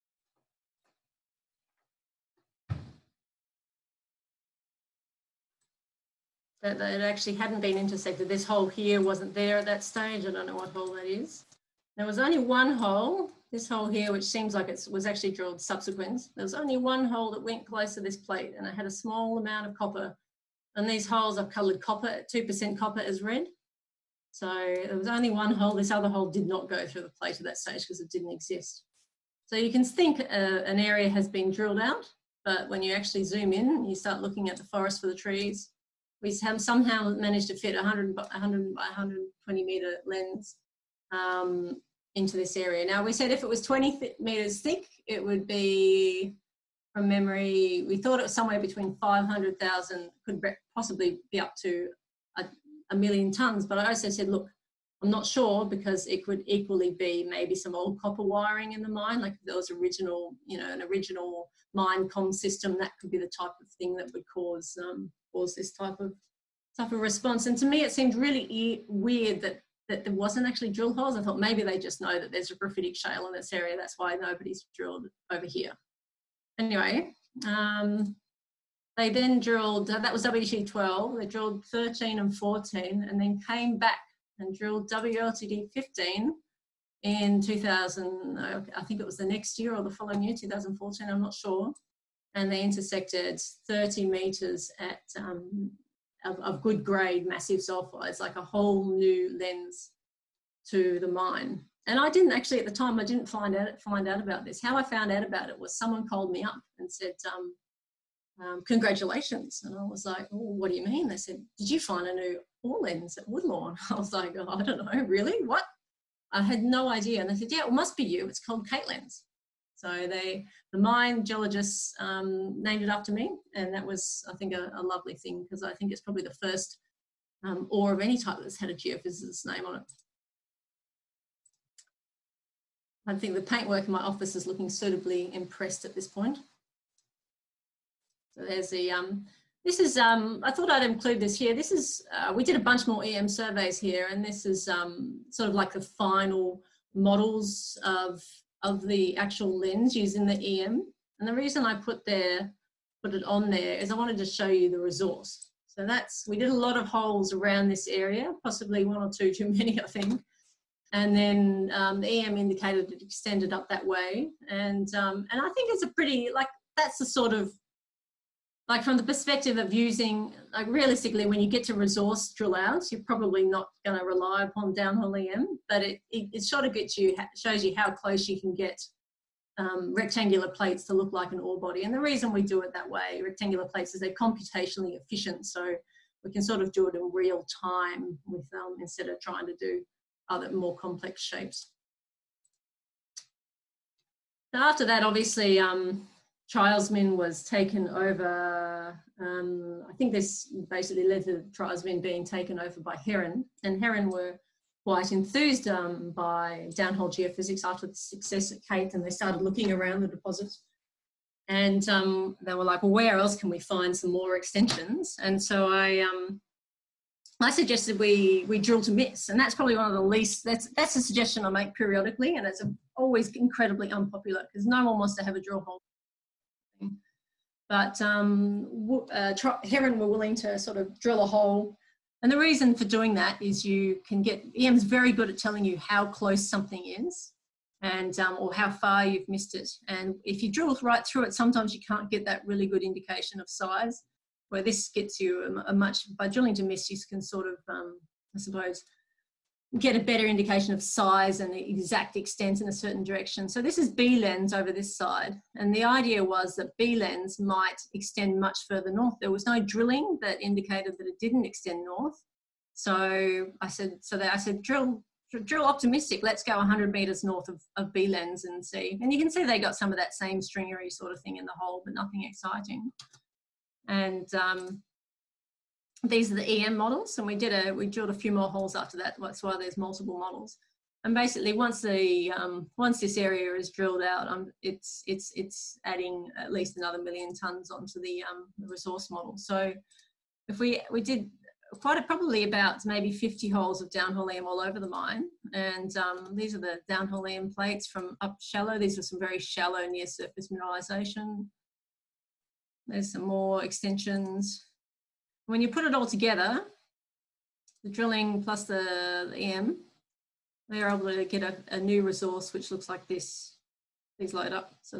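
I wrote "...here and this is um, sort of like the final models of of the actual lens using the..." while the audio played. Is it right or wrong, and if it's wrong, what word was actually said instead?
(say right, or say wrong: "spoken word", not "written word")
right.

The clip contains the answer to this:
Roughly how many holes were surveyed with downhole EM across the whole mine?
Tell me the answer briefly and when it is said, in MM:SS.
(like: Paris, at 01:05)
50, at 04:53.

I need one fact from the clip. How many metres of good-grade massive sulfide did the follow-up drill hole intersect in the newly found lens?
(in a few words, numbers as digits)
30 meters.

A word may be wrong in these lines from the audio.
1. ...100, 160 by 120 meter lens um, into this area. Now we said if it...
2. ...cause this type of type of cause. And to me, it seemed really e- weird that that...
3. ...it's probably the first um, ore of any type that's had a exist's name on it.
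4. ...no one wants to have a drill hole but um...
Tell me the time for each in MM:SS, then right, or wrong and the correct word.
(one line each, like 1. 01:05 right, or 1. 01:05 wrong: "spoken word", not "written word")
1. 00:37 wrong: "100", not "160"
2. 01:05 wrong: "response", not "cause"
3. 02:05 wrong: "geophysicist", not "exist"
4. 03:44 right.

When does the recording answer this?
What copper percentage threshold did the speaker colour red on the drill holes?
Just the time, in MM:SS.
00:22.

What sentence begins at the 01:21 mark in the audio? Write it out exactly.
They drilled 13 and 14, and then came back and drilled WLTD 15 in 2000.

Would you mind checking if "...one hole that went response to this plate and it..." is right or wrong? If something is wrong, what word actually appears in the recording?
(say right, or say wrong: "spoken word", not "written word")
wrong: "close", not "response".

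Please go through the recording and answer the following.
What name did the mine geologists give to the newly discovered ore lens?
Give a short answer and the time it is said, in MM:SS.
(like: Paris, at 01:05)
Kate lens, at 01:58.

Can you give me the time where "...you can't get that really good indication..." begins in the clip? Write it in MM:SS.
04:01.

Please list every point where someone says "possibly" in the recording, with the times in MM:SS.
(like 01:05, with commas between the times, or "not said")
00:50, 02:38.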